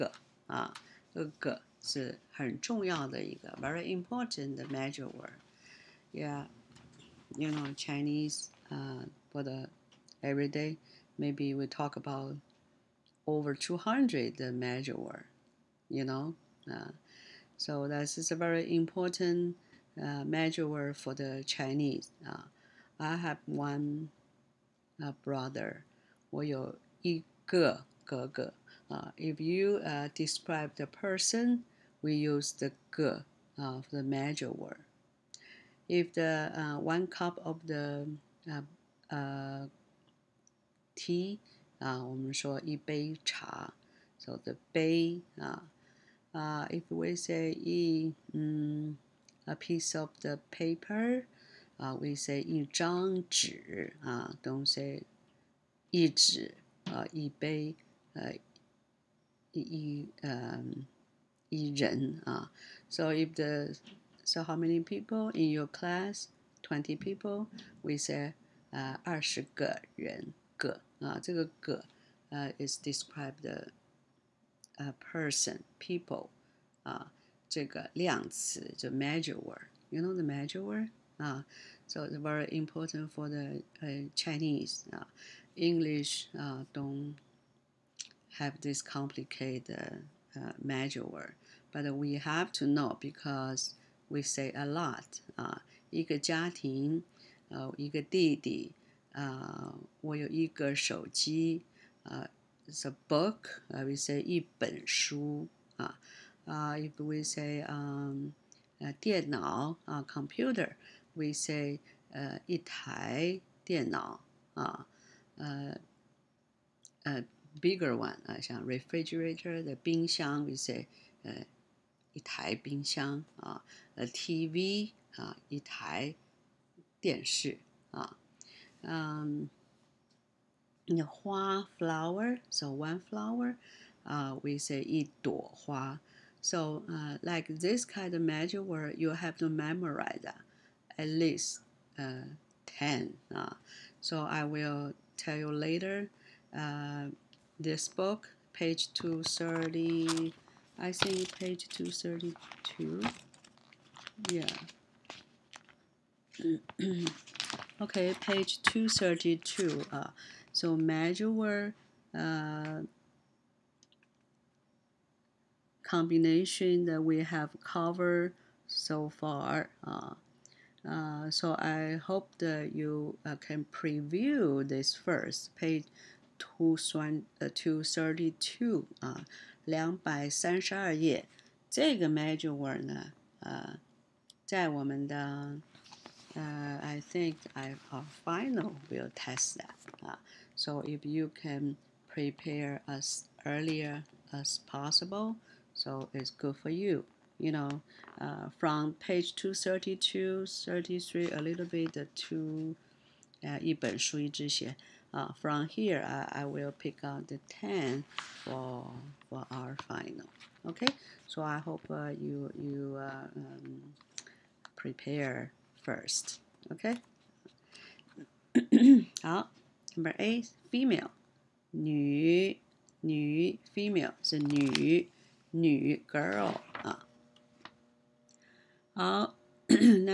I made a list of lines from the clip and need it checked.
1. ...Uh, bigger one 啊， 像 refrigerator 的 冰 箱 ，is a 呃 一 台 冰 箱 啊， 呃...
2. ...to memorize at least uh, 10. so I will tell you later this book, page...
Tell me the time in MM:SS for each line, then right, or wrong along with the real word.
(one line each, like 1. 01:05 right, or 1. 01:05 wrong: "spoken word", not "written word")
1. 01:57 right
2. 02:19 right.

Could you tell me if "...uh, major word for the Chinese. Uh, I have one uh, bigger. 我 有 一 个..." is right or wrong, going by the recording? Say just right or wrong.
wrong.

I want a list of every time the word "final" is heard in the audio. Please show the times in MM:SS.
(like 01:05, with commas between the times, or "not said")
03:08, 03:29.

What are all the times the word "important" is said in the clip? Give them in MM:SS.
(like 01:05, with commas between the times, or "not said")
00:03, 00:18, 01:22.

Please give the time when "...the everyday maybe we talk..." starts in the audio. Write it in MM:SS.
00:09.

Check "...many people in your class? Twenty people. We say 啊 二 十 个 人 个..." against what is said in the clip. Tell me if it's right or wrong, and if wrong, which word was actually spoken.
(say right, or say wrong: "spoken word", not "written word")
right.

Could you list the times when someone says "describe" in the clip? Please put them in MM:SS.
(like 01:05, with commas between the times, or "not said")
00:30, 01:12.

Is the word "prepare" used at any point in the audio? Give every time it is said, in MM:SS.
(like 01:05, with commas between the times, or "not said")
03:12, 03:34.